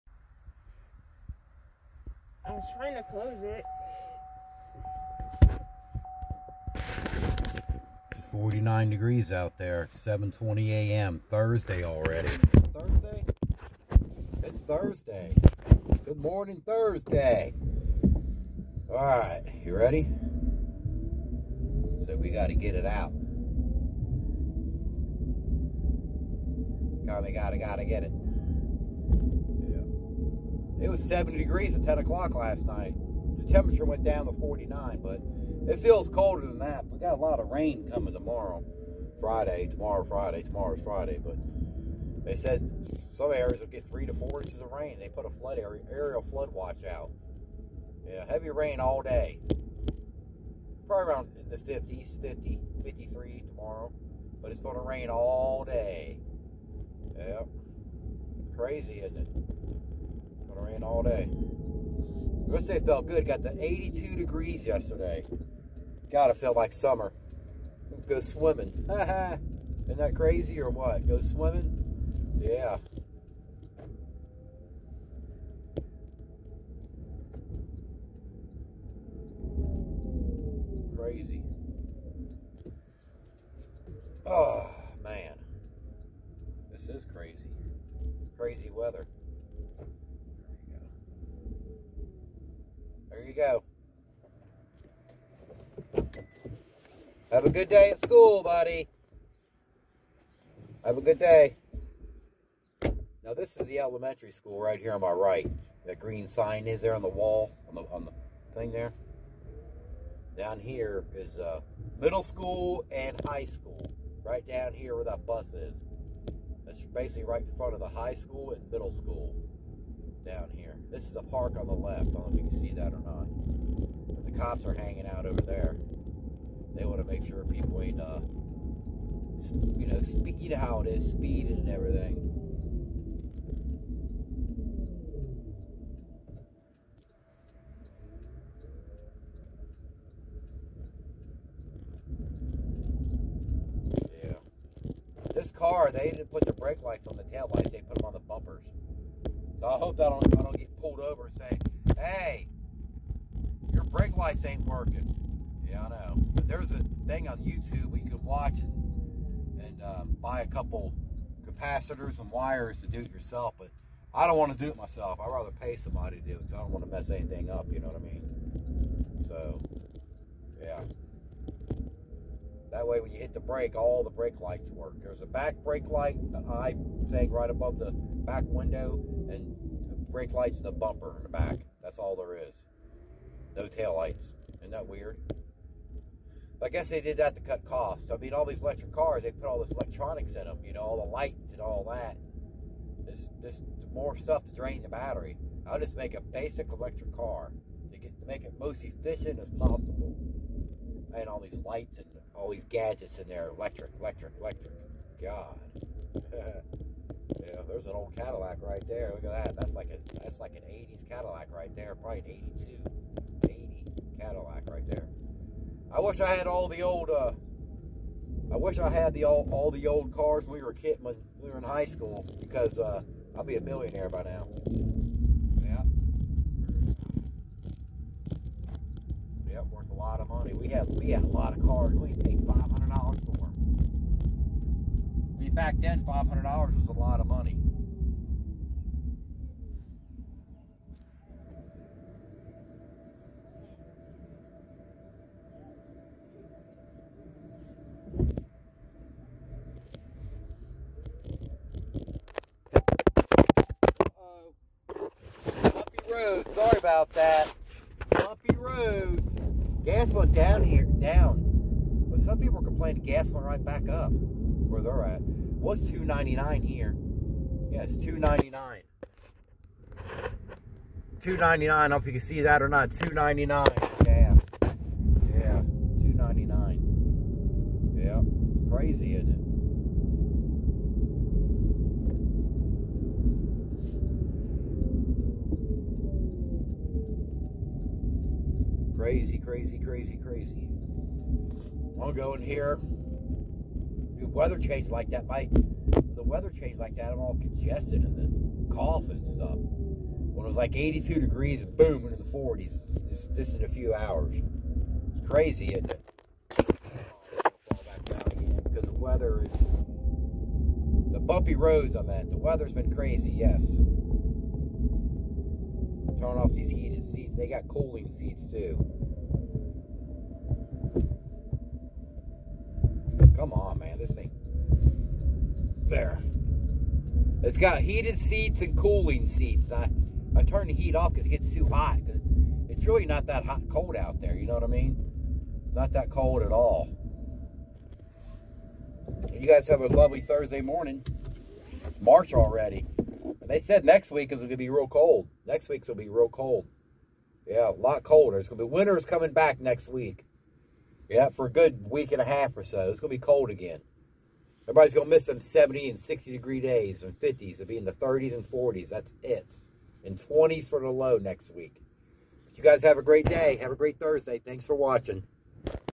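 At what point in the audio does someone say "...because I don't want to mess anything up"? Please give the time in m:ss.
2:46.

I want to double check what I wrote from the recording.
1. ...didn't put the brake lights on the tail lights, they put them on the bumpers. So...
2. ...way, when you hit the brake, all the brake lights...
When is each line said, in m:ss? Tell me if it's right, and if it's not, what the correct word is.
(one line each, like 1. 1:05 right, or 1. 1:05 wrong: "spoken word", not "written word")
1. 2:26 right
2. 2:52 right.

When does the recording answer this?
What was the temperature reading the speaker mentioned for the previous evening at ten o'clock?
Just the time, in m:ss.
0:31.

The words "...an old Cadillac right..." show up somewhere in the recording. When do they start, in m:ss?
3:27.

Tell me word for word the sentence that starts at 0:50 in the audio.
Probably around in the 50s, 50, 53 tomorrow.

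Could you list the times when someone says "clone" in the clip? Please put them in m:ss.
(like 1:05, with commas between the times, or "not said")
not said.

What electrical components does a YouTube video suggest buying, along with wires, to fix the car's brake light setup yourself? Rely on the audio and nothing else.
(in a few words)
capacitors.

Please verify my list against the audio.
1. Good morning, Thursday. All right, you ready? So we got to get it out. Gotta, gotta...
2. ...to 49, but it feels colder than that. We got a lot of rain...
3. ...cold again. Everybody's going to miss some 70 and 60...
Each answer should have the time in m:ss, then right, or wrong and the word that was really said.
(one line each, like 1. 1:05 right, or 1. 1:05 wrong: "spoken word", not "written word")
1. 0:16 right
2. 0:34 right
3. 5:53 right.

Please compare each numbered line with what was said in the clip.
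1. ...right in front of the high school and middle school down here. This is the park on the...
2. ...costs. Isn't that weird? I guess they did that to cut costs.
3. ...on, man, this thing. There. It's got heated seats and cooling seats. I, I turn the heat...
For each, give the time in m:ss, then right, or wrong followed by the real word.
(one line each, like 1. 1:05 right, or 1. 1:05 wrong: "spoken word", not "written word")
1. 1:57 right
2. 3:03 wrong: "lights", not "costs"
3. 5:23 right.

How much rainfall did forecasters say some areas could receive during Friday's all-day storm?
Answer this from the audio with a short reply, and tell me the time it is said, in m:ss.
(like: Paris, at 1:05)
3 to 4 inches, at 0:43.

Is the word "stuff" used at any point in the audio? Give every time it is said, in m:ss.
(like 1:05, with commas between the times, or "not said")
3:14, 4:59.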